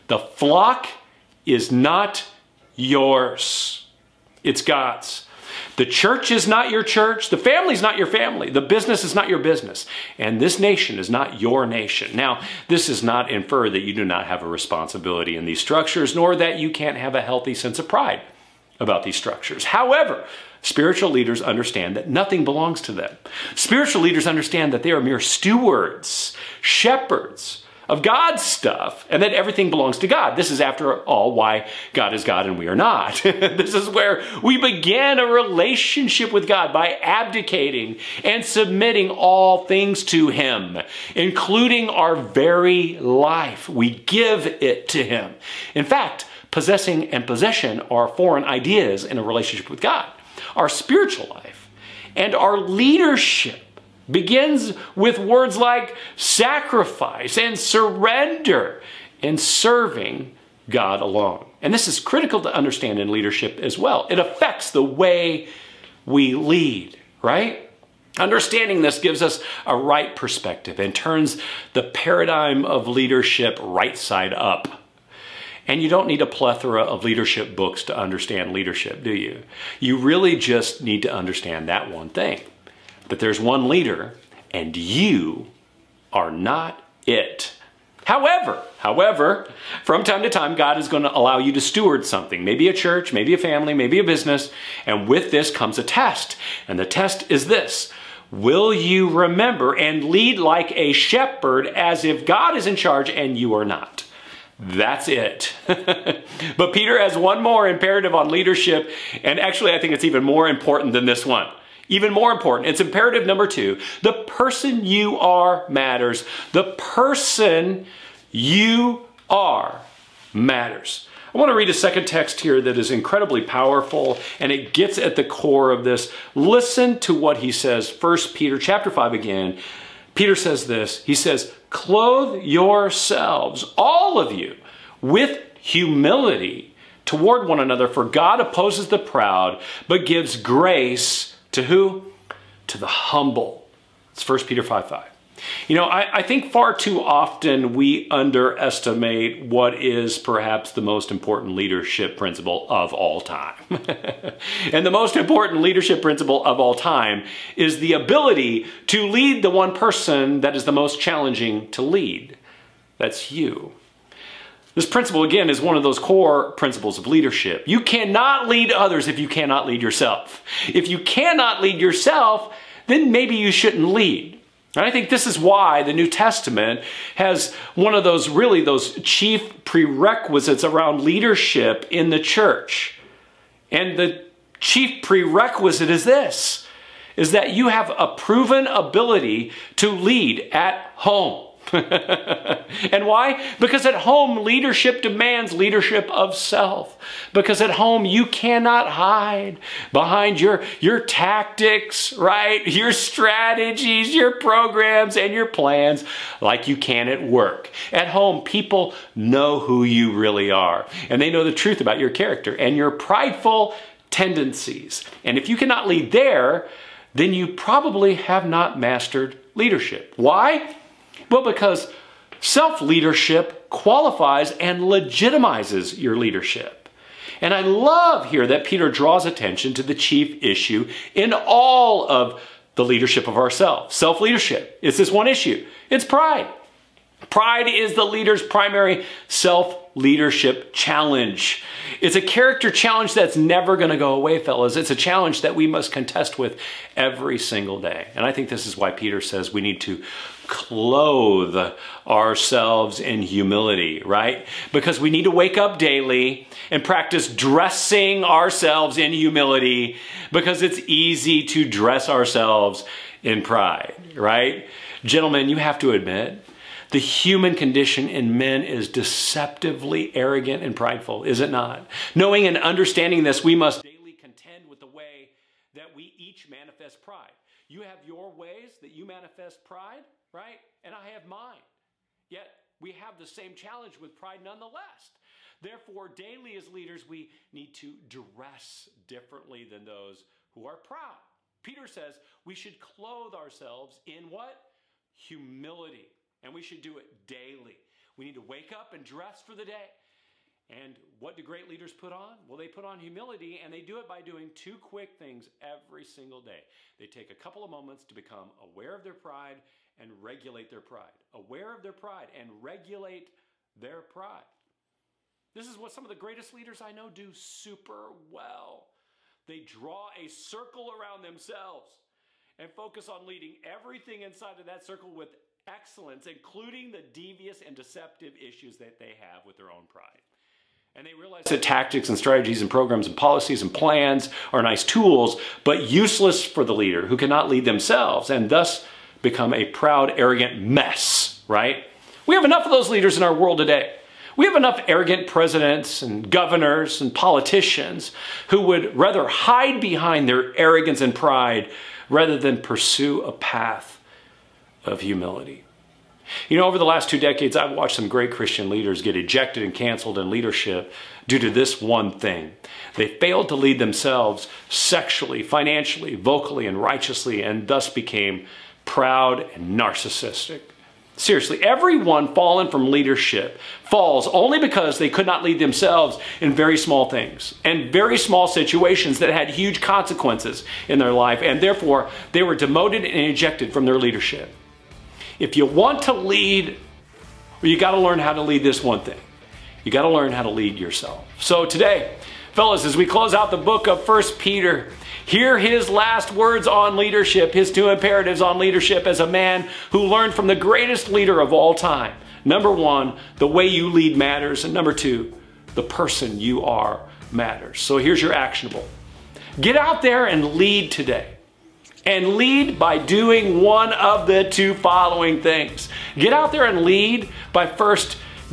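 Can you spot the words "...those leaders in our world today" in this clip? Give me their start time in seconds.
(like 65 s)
342 s.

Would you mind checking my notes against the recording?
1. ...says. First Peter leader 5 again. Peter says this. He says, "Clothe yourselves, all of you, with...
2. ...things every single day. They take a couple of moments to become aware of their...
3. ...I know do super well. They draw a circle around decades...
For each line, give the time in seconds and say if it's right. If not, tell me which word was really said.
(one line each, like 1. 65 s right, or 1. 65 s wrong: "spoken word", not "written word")
1. 127 s wrong: "chapter", not "leader"
2. 305 s right
3. 316 s wrong: "themselves", not "decades".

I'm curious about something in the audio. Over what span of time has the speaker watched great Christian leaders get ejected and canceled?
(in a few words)
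Two decades.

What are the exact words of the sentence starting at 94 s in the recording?
And with this comes a test.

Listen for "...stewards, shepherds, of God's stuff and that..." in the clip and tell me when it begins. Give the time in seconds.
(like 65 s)
25 s.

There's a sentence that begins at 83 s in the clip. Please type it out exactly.
That there's one leader, and you are not it.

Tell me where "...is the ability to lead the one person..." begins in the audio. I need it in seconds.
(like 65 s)
157 s.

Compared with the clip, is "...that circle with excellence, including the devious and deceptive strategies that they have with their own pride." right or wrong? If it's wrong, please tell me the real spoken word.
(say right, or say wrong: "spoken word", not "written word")
wrong: "issues", not "strategies".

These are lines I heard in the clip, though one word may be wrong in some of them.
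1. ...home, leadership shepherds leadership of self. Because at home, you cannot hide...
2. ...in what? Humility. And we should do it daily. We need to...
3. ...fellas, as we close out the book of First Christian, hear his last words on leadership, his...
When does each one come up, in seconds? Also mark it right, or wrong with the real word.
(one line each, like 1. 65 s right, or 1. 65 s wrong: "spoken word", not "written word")
1. 193 s wrong: "demands", not "shepherds"
2. 294 s right
3. 392 s wrong: "Peter", not "Christian".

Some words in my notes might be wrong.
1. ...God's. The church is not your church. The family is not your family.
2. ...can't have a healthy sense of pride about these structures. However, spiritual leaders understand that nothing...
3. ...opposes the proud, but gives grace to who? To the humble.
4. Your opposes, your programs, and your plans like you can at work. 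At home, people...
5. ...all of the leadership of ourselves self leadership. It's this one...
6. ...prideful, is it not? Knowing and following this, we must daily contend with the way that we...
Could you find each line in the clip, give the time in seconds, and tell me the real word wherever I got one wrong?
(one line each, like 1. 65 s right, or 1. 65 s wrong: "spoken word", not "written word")
1. 4 s right
2. 16 s right
3. 138 s right
4. 202 s wrong: "strategies", not "opposes"
5. 231 s right
6. 270 s wrong: "understanding", not "following".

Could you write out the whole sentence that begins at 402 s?
Number one, the way you lead matters.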